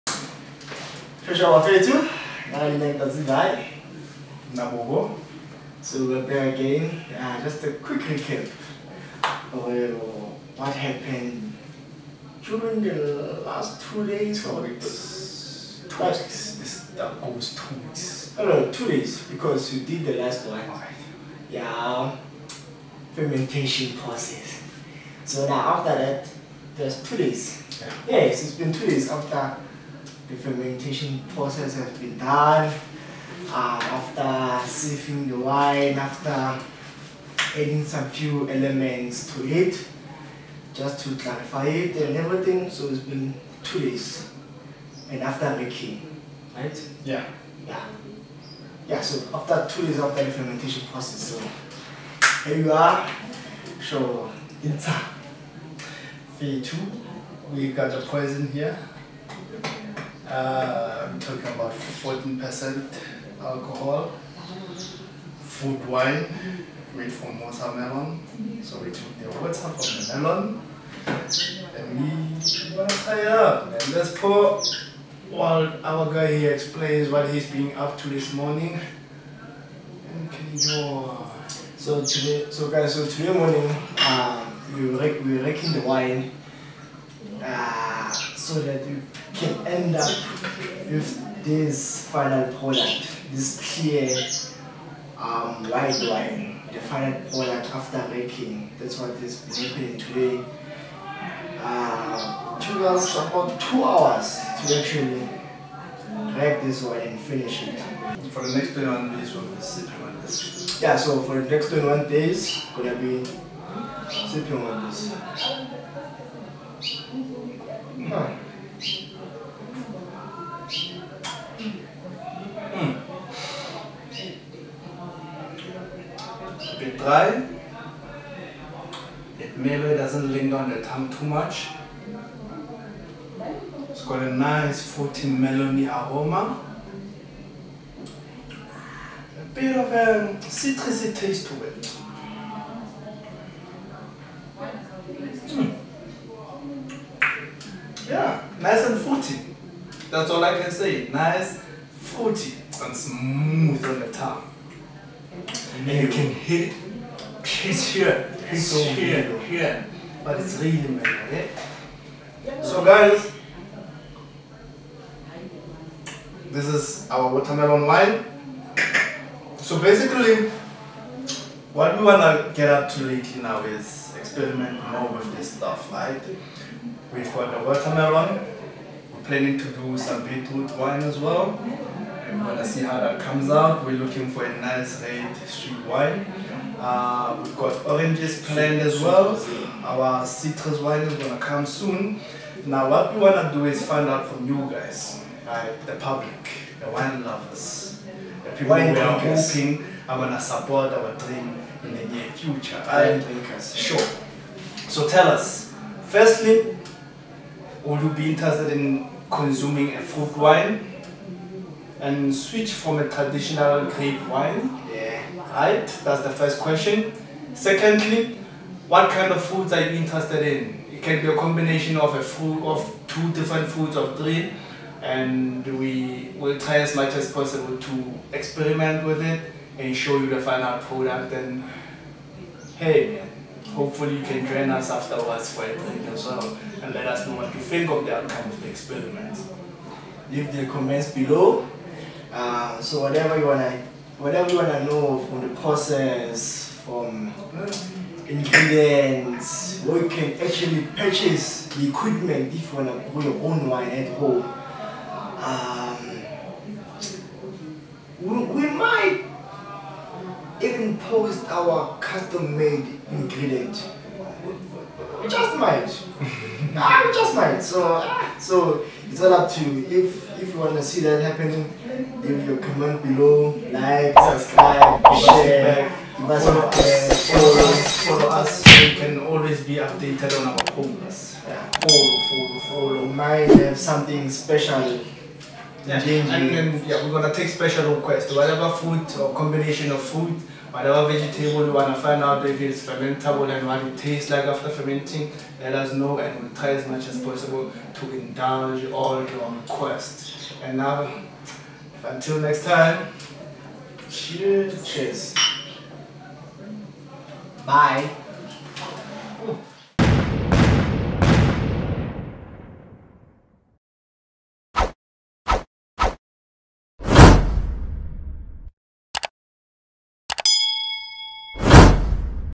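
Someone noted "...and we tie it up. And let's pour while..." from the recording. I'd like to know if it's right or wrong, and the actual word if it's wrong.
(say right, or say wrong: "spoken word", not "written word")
right.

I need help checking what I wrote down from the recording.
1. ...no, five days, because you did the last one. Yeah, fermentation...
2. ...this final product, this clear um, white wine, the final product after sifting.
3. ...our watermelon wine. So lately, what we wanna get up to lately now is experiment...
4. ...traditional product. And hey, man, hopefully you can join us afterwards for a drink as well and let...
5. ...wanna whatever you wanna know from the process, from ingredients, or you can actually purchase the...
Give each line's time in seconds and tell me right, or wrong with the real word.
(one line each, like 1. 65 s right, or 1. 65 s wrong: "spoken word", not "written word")
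1. 18 s wrong: "two", not "five"
2. 91 s wrong: "making", not "sifting"
3. 167 s wrong: "basically", not "lately"
4. 230 s wrong: "final", not "traditional"
5. 243 s right.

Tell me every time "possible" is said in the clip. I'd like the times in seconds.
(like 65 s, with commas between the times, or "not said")
227 s, 297 s.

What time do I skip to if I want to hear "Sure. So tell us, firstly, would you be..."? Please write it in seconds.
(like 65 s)
203 s.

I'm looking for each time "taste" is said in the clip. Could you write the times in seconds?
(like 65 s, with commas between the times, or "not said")
141 s, 293 s.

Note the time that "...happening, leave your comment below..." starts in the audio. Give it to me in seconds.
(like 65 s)
271 s.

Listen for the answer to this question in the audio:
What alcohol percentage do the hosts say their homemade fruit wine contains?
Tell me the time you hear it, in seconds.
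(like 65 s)
61 s.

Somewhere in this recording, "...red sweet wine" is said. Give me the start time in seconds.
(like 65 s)
185 s.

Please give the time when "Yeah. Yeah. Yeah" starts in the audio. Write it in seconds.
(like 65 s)
47 s.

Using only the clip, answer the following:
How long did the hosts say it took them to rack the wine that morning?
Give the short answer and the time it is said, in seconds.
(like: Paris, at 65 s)
2 hours, at 103 s.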